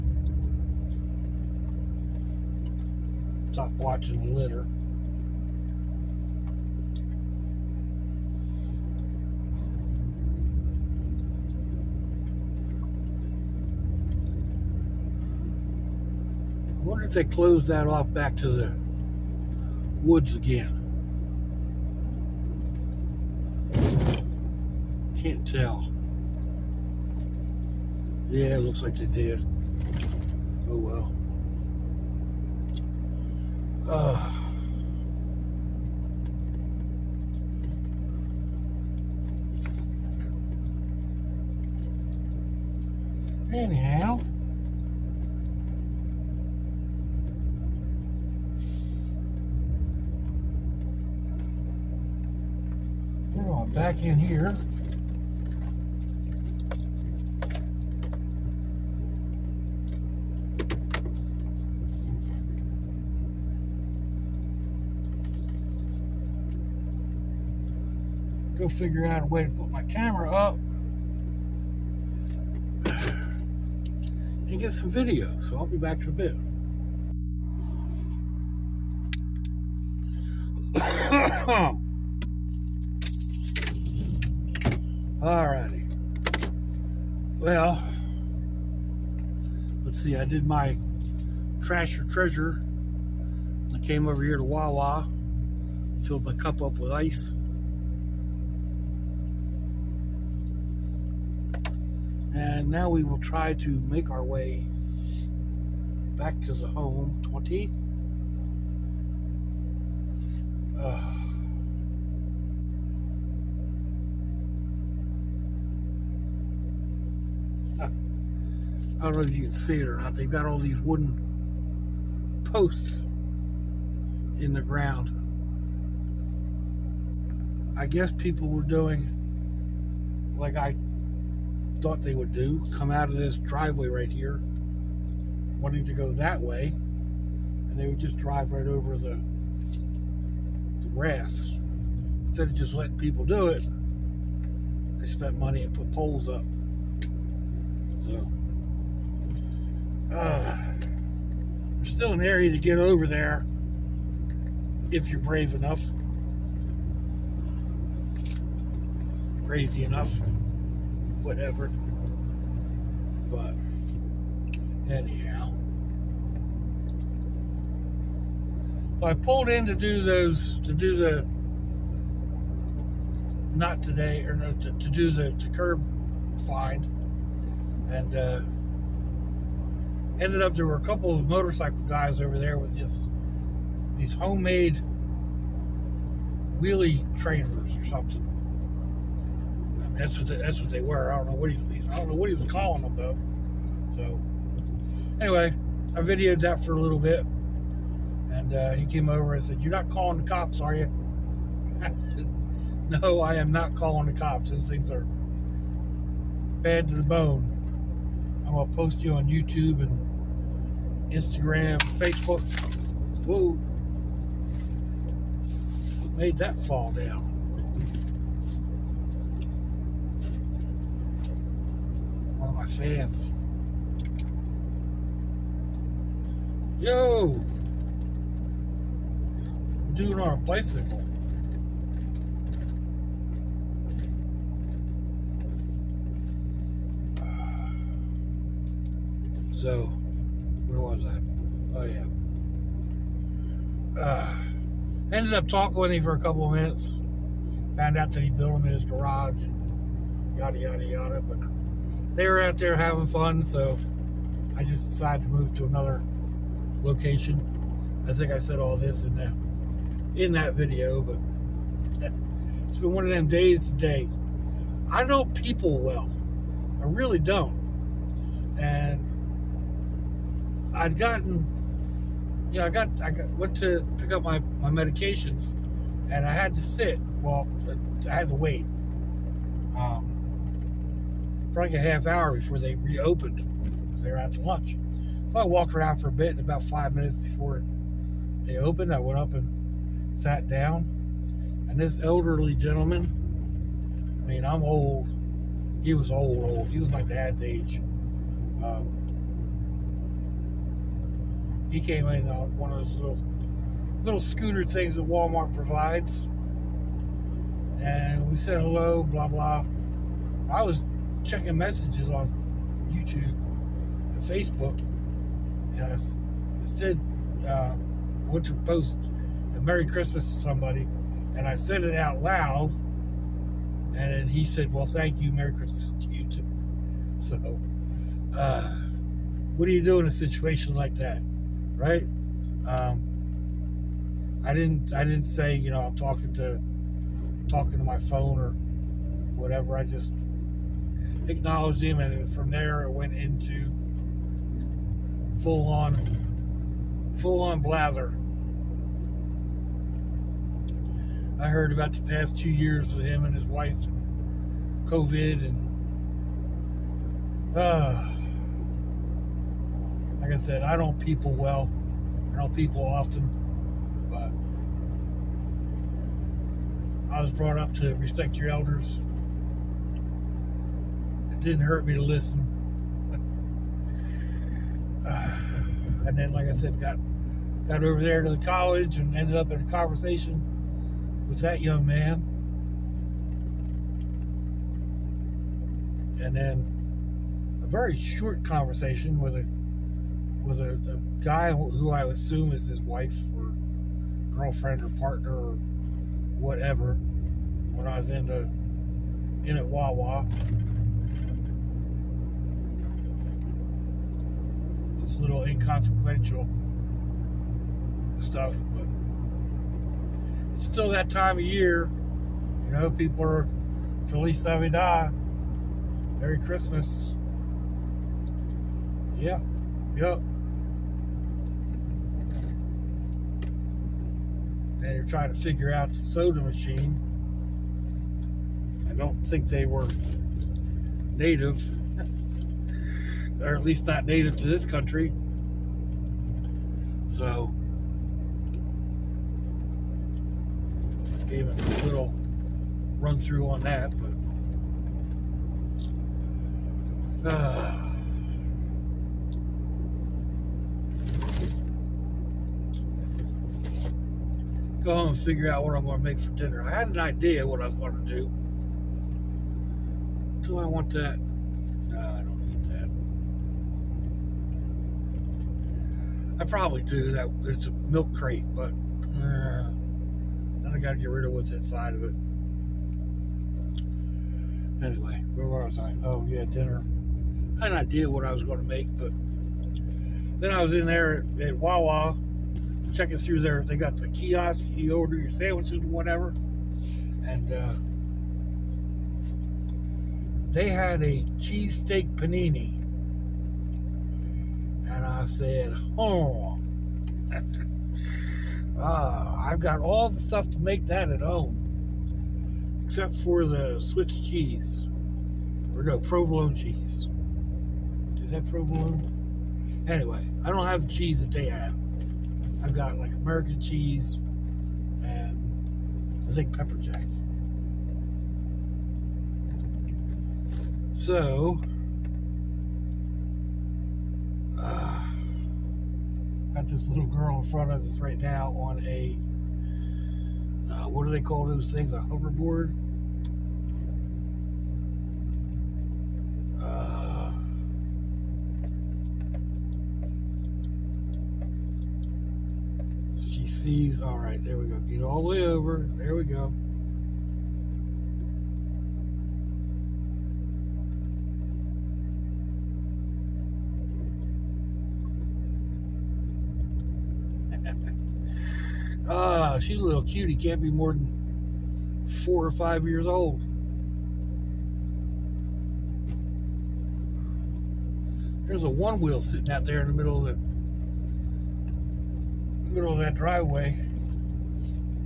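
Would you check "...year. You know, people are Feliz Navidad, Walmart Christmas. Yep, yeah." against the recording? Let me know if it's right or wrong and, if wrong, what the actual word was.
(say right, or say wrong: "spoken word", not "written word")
wrong: "Merry", not "Walmart".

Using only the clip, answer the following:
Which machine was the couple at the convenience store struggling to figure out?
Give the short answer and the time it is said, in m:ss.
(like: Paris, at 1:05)
Soda machine, at 7:06.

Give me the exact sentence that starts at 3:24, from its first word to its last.
Those things are bad to the bone." I'm gonna post you on YouTube and Instagram, Facebook.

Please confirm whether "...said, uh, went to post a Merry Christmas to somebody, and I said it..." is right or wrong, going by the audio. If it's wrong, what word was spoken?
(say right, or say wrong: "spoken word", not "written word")
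right.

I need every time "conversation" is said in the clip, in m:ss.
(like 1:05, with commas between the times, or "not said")
6:19, 6:28.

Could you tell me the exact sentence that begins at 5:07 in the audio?
And we said hello, blah blah.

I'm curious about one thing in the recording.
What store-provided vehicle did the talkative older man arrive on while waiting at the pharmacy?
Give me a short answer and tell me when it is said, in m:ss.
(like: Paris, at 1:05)
Scooter, at 5:04.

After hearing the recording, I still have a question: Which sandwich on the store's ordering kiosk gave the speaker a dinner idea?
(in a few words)
Cheesesteak panini.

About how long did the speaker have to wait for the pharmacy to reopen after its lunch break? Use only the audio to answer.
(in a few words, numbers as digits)
Half hour.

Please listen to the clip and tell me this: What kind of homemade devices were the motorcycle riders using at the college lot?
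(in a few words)
Wheelie trainers.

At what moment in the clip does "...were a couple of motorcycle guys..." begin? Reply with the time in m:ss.
3:00.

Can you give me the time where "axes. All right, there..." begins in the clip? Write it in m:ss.
9:03.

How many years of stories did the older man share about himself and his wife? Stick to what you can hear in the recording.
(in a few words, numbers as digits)
2.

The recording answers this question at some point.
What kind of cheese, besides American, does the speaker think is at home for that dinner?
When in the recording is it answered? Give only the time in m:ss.
8:36.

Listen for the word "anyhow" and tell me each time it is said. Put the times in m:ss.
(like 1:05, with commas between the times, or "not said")
0:43, 2:44.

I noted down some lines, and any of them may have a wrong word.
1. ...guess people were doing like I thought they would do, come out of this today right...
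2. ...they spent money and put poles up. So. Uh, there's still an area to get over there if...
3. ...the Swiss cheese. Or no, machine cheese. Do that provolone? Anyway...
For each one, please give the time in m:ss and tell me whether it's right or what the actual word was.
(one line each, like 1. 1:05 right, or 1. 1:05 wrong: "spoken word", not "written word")
1. 2:07 wrong: "driveway", not "today"
2. 2:25 right
3. 8:23 wrong: "provolone", not "machine".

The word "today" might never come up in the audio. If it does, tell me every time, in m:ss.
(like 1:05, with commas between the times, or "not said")
2:53, 4:23.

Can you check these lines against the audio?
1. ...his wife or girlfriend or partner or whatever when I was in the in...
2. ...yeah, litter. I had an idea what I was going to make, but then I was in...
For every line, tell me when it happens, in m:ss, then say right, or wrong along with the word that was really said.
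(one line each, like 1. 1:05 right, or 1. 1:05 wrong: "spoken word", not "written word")
1. 6:32 right
2. 7:56 wrong: "dinner", not "litter".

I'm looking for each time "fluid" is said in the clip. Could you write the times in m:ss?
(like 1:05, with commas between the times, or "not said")
not said.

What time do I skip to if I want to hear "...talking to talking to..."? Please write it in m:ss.
5:35.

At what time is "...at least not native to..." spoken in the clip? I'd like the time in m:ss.
7:13.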